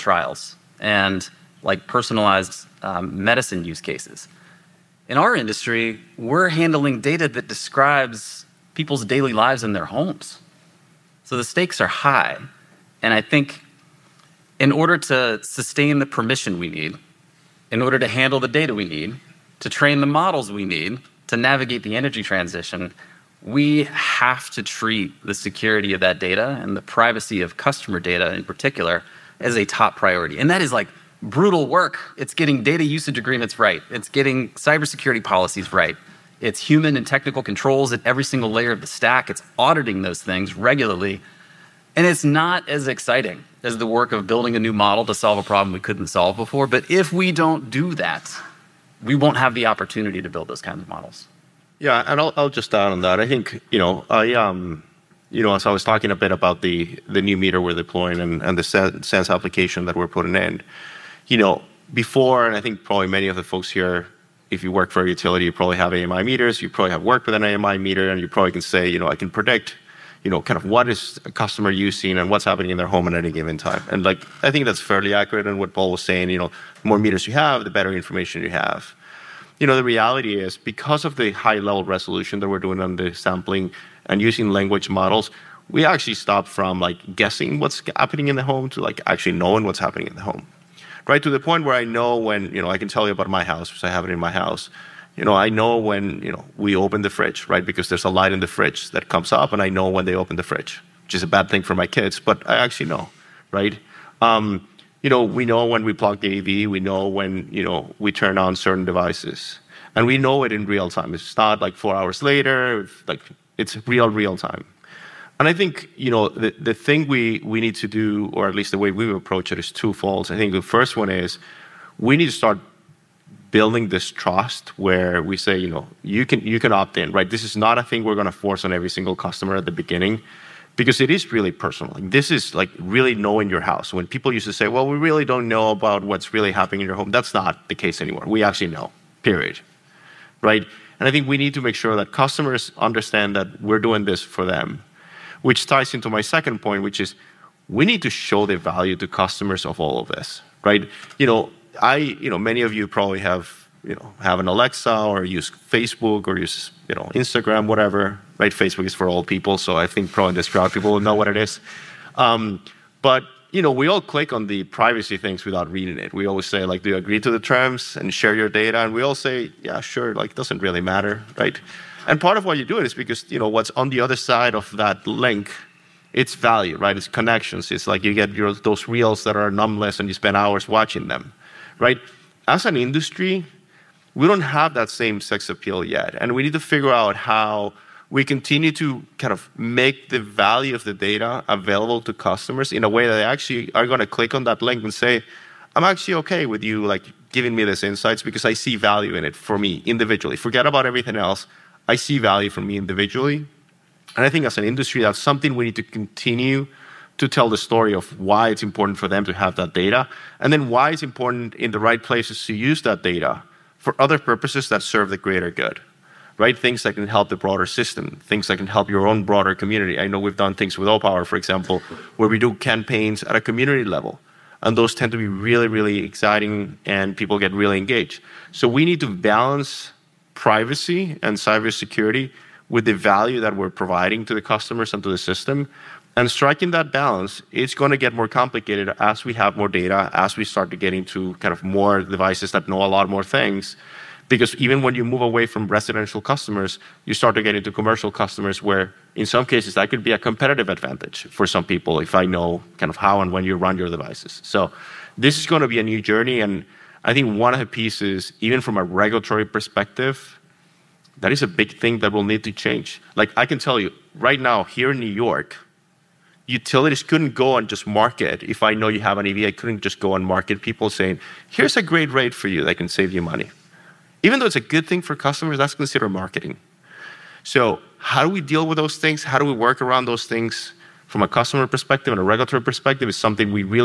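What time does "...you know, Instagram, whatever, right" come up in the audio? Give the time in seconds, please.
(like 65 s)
156 s.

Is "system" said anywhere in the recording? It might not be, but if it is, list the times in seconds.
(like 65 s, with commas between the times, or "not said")
217 s, 235 s.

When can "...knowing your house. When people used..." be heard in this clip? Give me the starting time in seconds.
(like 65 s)
133 s.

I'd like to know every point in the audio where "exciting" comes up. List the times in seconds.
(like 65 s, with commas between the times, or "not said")
42 s, 226 s.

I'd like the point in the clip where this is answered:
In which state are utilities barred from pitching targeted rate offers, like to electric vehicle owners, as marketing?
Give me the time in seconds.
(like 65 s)
264 s.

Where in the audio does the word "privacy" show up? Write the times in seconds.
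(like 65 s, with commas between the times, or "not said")
26 s, 164 s, 230 s.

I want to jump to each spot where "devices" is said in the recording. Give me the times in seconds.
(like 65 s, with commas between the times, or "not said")
108 s, 242 s, 253 s.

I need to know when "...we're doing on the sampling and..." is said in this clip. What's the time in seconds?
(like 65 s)
82 s.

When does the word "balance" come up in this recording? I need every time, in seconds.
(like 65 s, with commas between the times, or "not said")
229 s, 236 s.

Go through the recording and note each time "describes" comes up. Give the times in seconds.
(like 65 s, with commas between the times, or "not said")
7 s.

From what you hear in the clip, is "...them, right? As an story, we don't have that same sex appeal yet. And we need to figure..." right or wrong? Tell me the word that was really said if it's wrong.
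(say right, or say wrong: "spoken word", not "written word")
wrong: "industry", not "story".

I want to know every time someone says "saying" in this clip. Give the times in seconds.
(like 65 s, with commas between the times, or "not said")
76 s, 270 s.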